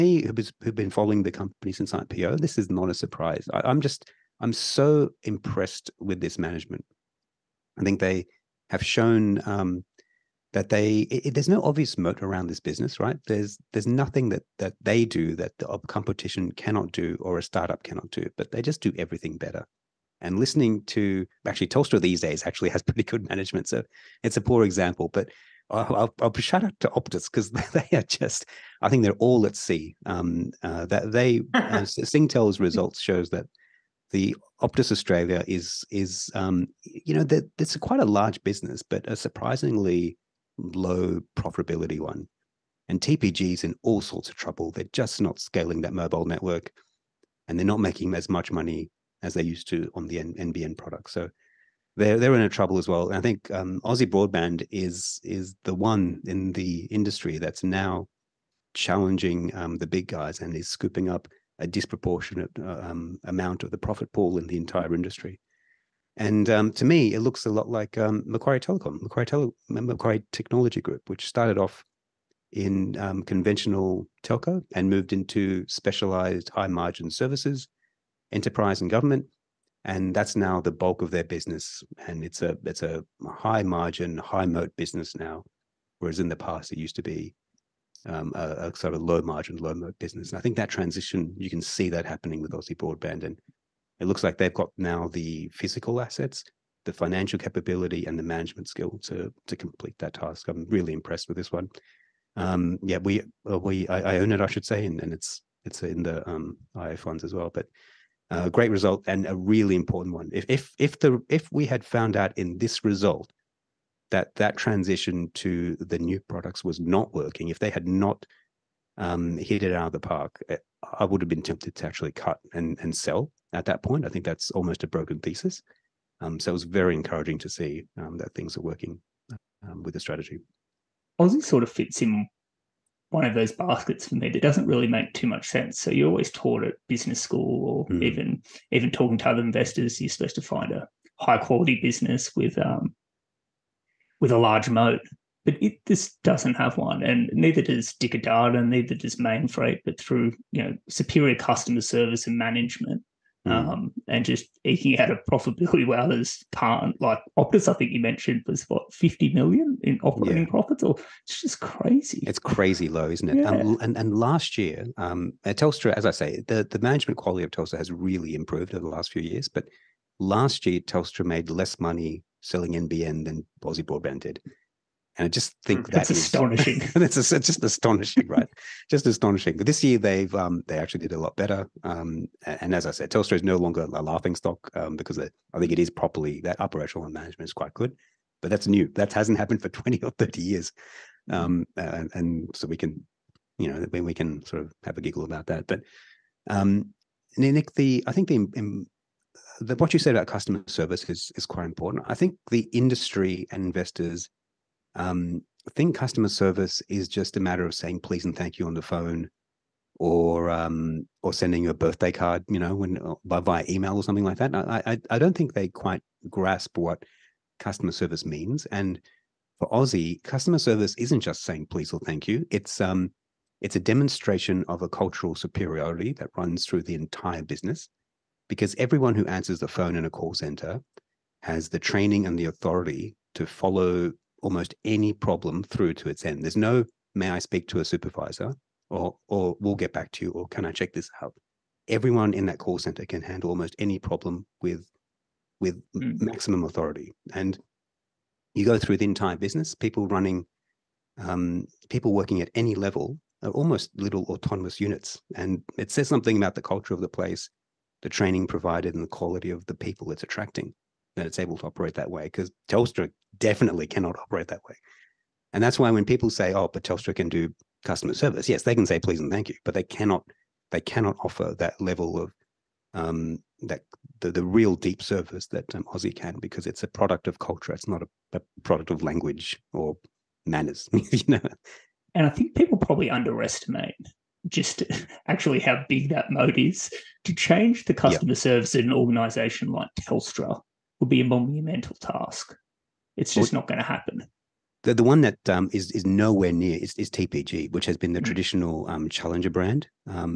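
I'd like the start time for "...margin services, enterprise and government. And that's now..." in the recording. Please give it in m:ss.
1:16.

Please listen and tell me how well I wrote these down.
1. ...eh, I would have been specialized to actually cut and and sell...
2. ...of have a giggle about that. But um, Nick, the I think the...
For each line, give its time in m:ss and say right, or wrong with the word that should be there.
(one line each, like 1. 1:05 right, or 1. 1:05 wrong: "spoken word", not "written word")
1. 2:00 wrong: "tempted", not "specialized"
2. 3:14 right.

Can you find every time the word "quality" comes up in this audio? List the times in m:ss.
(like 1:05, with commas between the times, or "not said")
2:21, 2:47, 4:19.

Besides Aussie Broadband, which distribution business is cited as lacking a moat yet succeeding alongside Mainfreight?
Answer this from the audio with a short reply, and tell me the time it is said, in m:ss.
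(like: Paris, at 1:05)
Dicker Data, at 2:27.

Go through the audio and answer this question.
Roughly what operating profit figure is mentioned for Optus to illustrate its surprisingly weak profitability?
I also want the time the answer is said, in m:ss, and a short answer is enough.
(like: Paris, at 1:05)
50 million, at 2:38.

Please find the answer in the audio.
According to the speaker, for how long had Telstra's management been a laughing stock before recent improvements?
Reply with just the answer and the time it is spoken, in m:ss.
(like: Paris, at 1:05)
20 or 30 years, at 3:09.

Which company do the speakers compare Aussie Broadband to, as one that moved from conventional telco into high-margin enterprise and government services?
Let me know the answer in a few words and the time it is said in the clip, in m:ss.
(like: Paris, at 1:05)
Macquarie Technology Group, at 1:09.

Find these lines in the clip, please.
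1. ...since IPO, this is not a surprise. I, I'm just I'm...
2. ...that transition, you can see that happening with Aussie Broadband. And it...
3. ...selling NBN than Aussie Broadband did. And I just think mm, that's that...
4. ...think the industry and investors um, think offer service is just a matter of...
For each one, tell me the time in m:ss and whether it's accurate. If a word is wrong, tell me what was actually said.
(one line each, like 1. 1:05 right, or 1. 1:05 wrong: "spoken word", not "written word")
1. 0:01 right
2. 1:30 right
3. 2:52 right
4. 3:22 wrong: "customer", not "offer".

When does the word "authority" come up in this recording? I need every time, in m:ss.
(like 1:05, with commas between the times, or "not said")
3:52, 4:06.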